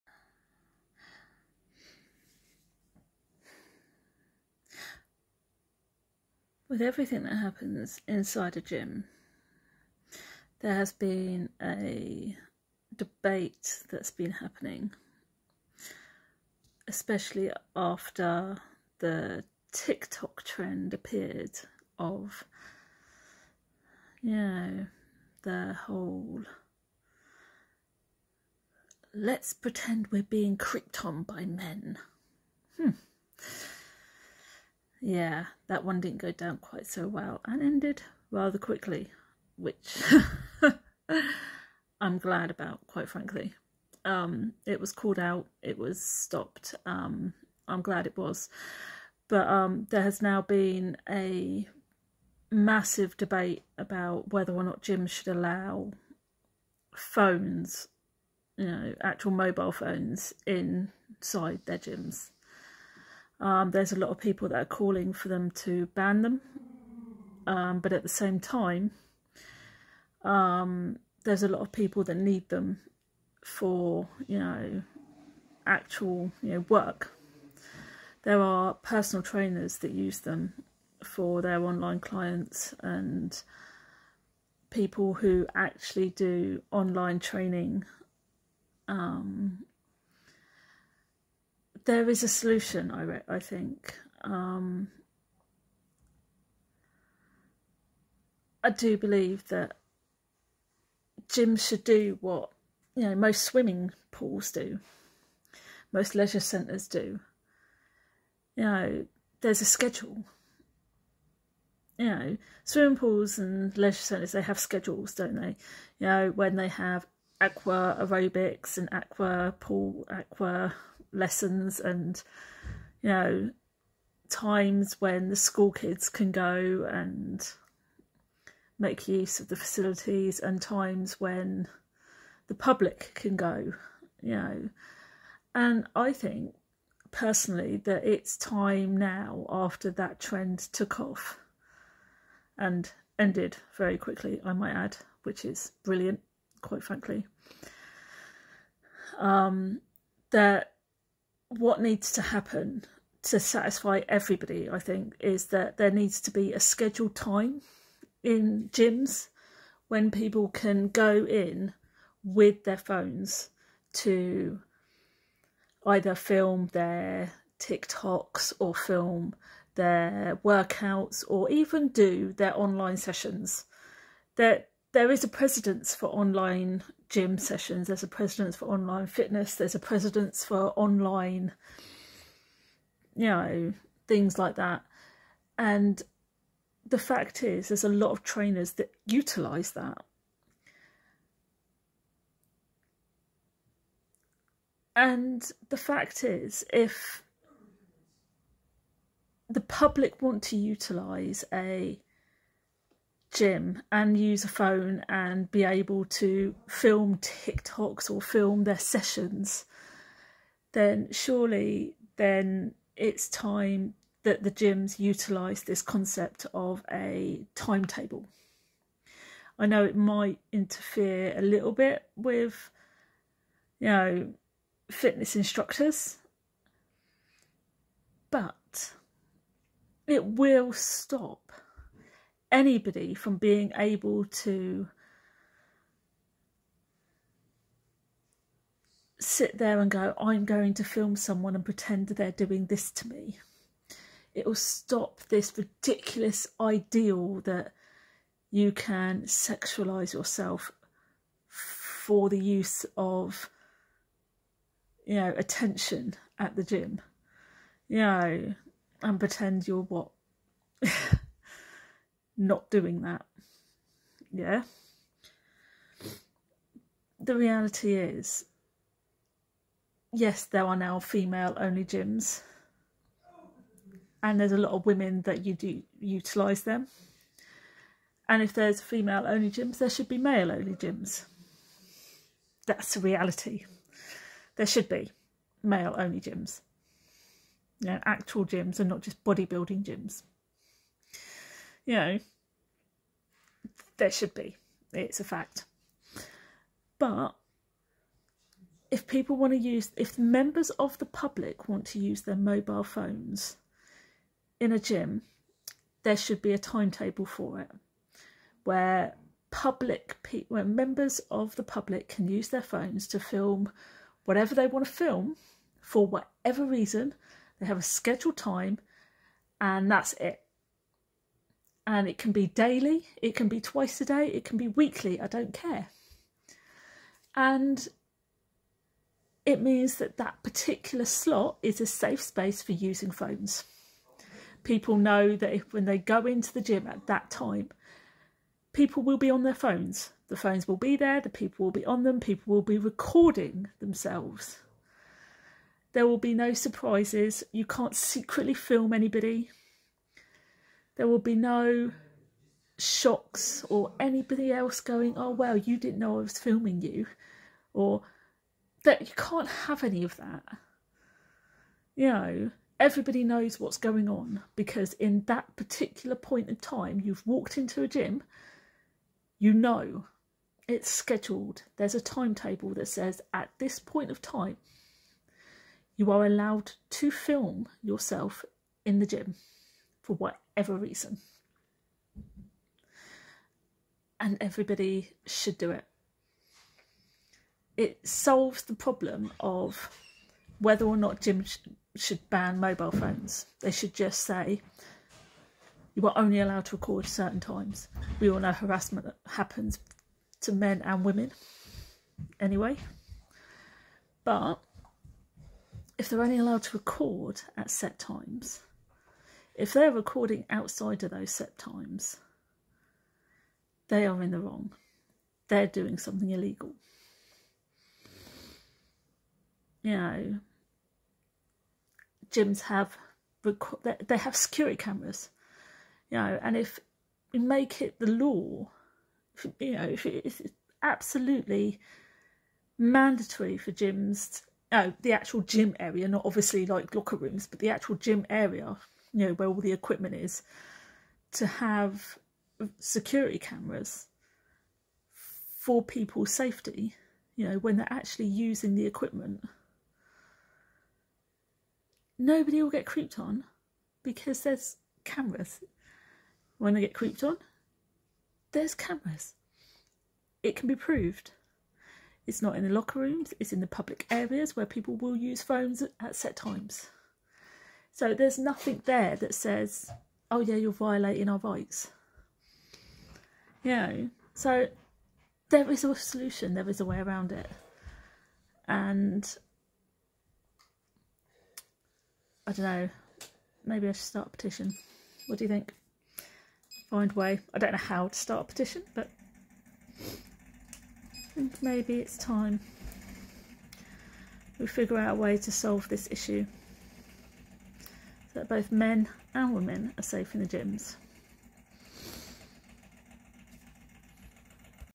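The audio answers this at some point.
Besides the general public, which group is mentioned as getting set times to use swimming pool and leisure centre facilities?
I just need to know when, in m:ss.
2:05.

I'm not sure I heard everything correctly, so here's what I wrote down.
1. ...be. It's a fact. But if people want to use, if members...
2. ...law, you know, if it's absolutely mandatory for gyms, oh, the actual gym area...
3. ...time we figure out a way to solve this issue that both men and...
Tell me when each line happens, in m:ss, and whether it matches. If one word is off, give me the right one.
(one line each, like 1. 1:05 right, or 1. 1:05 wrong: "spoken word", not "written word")
1. 4:54 right
2. 7:08 right
3. 8:12 right.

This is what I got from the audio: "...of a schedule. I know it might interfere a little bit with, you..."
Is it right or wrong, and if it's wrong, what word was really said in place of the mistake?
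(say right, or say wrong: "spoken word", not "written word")
wrong: "timetable", not "schedule".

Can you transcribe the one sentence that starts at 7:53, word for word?
You know, so there is a solution, there is a way around it.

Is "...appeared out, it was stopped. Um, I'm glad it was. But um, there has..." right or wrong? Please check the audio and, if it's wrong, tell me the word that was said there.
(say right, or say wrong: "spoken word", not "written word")
wrong: "called", not "appeared".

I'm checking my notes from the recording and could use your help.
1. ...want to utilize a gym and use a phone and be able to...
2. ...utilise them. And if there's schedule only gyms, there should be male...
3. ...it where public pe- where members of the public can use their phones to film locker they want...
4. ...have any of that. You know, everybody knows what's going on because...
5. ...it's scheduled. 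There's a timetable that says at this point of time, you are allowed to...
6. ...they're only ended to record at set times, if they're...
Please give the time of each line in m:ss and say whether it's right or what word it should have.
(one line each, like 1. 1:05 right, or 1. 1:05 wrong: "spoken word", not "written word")
1. 3:20 right
2. 4:35 wrong: "female", not "schedule"
3. 5:07 wrong: "whatever", not "locker"
4. 5:59 right
5. 6:10 right
6. 6:46 wrong: "allowed", not "ended".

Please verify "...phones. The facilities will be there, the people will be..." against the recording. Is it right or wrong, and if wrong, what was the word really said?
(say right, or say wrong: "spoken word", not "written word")
wrong: "phones", not "facilities".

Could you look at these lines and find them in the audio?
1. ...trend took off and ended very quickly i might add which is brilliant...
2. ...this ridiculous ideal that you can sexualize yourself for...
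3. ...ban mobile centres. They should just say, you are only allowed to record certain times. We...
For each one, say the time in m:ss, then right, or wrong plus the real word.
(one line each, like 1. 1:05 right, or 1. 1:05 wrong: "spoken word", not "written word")
1. 2:20 right
2. 4:05 right
3. 6:32 wrong: "phones", not "centres".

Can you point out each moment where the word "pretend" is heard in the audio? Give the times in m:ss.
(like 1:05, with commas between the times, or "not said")
0:29, 4:01, 4:19.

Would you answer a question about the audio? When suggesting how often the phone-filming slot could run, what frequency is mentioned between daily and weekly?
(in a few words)
twice a day.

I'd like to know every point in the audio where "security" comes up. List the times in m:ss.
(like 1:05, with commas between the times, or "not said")
7:04, 7:22.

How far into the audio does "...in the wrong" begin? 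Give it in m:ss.
6:54.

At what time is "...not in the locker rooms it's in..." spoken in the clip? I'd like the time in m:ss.
7:42.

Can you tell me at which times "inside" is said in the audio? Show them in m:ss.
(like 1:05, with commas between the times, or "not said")
0:08, 1:00.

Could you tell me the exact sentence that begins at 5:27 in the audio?
And it means that that particular slot is a safe space for using phones.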